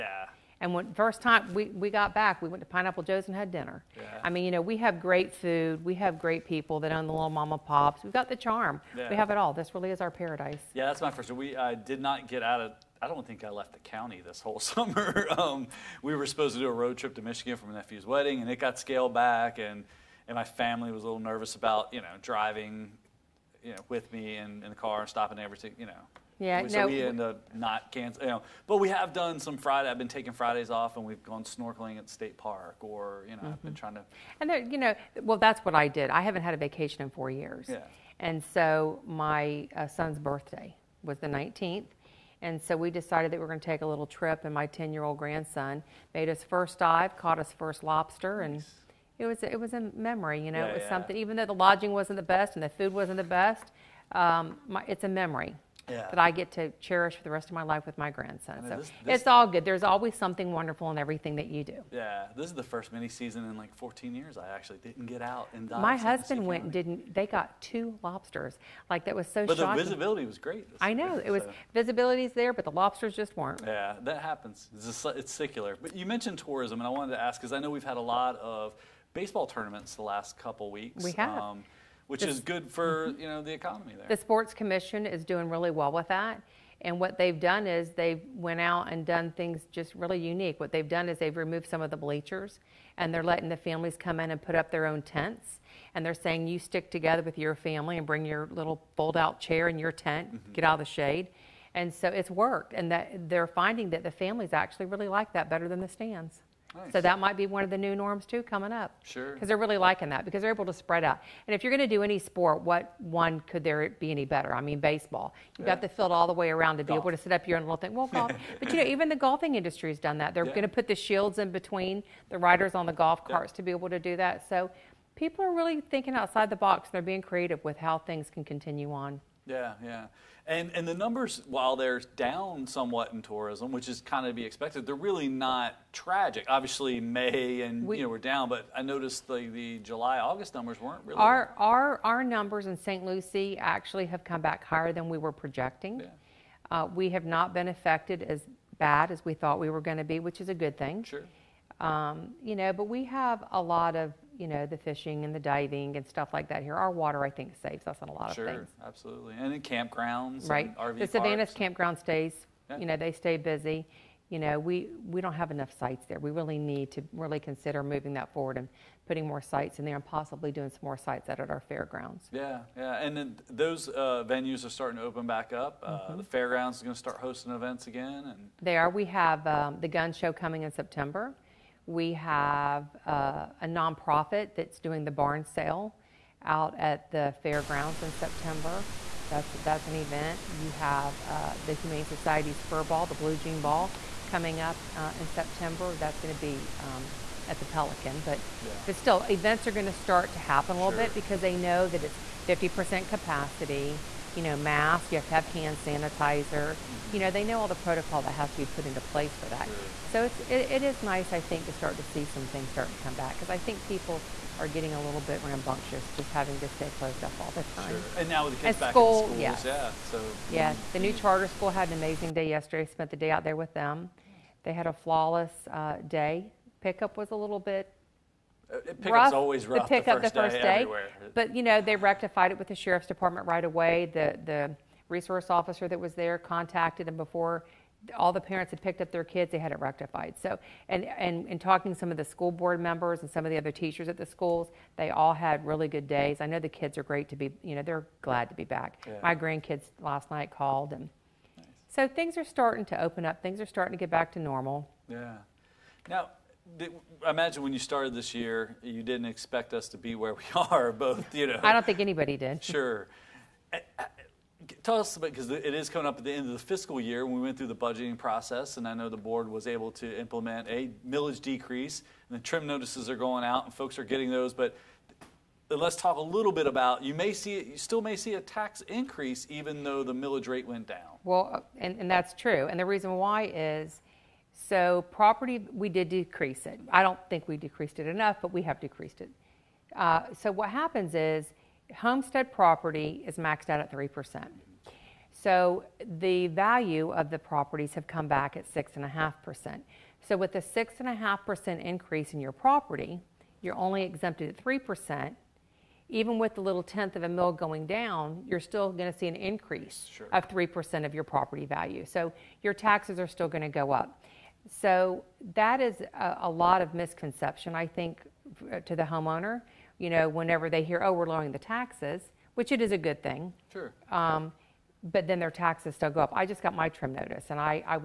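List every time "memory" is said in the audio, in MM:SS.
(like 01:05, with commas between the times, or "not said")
00:49, 00:55.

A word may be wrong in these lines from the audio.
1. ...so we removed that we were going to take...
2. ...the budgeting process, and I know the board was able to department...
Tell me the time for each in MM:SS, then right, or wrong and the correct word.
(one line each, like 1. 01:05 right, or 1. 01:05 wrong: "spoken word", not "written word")
1. 00:42 wrong: "decided", not "removed"
2. 04:27 wrong: "implement", not "department".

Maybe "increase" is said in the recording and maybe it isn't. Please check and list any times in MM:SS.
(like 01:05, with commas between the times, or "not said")
04:38, 05:01, 05:09.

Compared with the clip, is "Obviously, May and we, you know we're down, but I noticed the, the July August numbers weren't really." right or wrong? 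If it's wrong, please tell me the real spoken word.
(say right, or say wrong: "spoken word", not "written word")
right.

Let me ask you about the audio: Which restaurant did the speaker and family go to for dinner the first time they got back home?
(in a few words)
Pineapple Joe's.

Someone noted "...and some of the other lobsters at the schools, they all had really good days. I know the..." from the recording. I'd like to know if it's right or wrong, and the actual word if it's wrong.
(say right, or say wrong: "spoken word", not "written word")
wrong: "teachers", not "lobsters".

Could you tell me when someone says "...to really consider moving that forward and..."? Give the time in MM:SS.
02:46.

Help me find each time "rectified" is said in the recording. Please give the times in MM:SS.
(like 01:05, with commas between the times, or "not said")
03:51, 03:59.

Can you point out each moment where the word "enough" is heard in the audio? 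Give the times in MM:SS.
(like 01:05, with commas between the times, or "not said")
02:45, 04:48.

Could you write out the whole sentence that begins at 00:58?
I mean, so this, this, it's all good.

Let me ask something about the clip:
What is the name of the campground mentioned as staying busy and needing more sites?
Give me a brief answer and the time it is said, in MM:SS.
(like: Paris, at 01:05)
Savannas campground, at 02:41.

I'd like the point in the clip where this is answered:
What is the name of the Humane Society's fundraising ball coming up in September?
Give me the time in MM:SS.
03:13.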